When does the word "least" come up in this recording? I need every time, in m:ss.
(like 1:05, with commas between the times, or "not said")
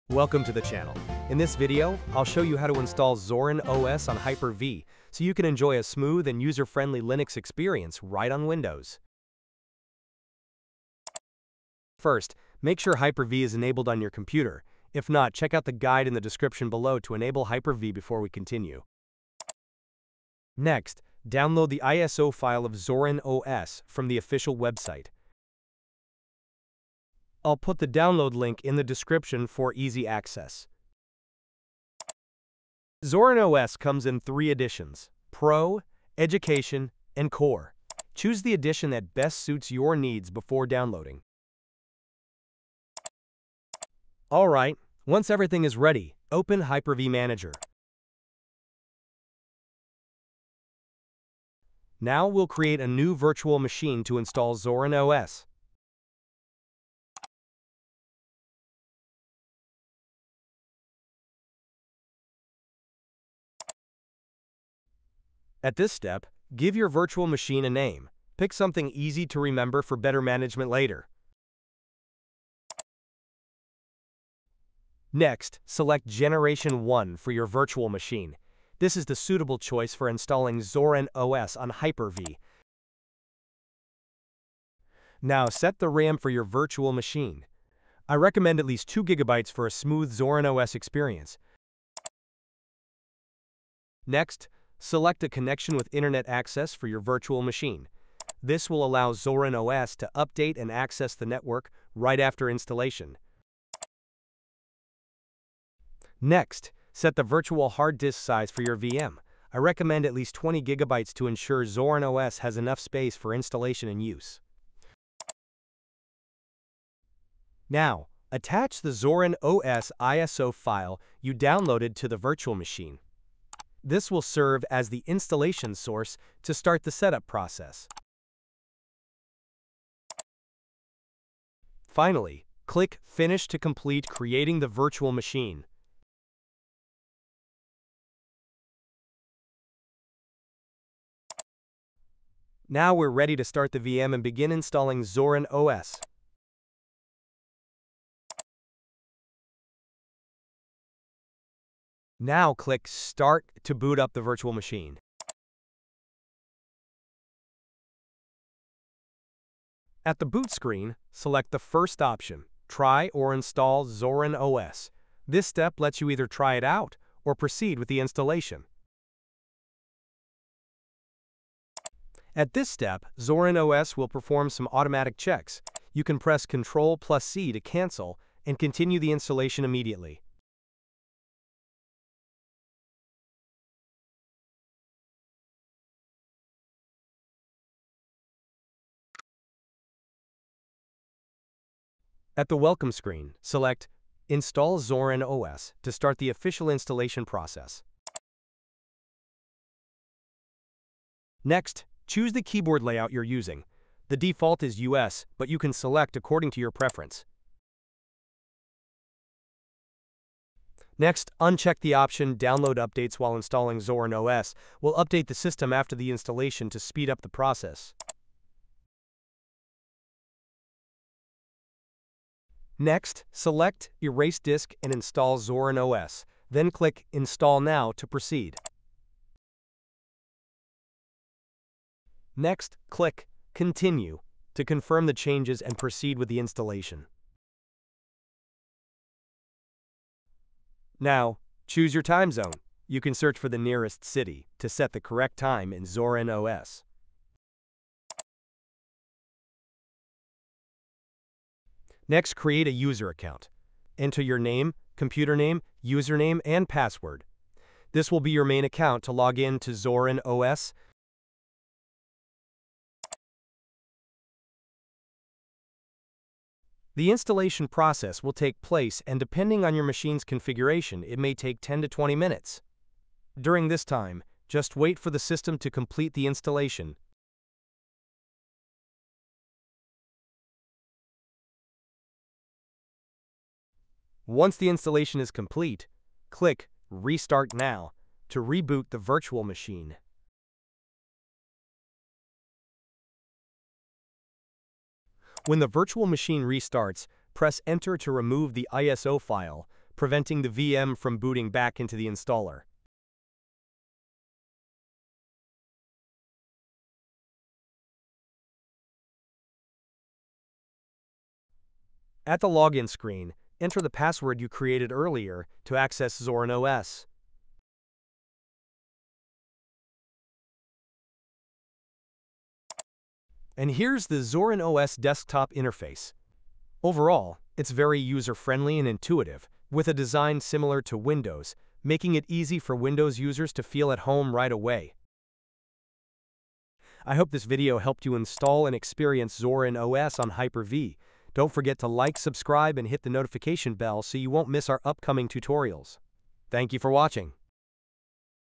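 1:28, 1:50.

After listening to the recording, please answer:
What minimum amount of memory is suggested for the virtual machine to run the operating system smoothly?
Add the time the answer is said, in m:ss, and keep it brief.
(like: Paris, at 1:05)
2 GB, at 1:28.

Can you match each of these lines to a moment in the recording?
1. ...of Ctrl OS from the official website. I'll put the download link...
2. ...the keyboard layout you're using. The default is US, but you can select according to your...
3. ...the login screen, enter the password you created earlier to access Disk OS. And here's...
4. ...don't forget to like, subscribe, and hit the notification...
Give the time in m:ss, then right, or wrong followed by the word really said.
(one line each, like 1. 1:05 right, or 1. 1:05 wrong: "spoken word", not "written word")
1. 0:22 wrong: "Zorin", not "Ctrl"
2. 3:22 right
3. 5:12 wrong: "Zorin", not "Disk"
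4. 5:41 right.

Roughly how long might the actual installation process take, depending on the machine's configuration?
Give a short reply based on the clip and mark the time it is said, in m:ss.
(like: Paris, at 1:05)
10 to 20 minutes, at 4:31.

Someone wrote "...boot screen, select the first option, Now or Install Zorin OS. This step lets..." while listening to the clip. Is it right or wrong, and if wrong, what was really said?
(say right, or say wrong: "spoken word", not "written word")
wrong: "Try", not "Now".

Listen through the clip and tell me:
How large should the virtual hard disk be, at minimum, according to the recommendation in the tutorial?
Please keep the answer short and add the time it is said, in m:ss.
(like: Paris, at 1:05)
20 gigabytes, at 1:50.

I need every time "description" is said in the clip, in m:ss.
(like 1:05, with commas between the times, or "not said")
0:16, 0:28.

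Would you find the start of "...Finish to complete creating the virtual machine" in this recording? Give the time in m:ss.
2:13.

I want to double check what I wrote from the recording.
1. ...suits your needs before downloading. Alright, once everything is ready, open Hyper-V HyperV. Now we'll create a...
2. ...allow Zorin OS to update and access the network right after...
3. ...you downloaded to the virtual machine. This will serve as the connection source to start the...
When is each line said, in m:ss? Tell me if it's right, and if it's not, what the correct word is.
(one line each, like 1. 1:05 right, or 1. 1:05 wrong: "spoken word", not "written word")
1. 0:39 wrong: "Manager", not "HyperV"
2. 1:38 right
3. 2:01 wrong: "installation", not "connection".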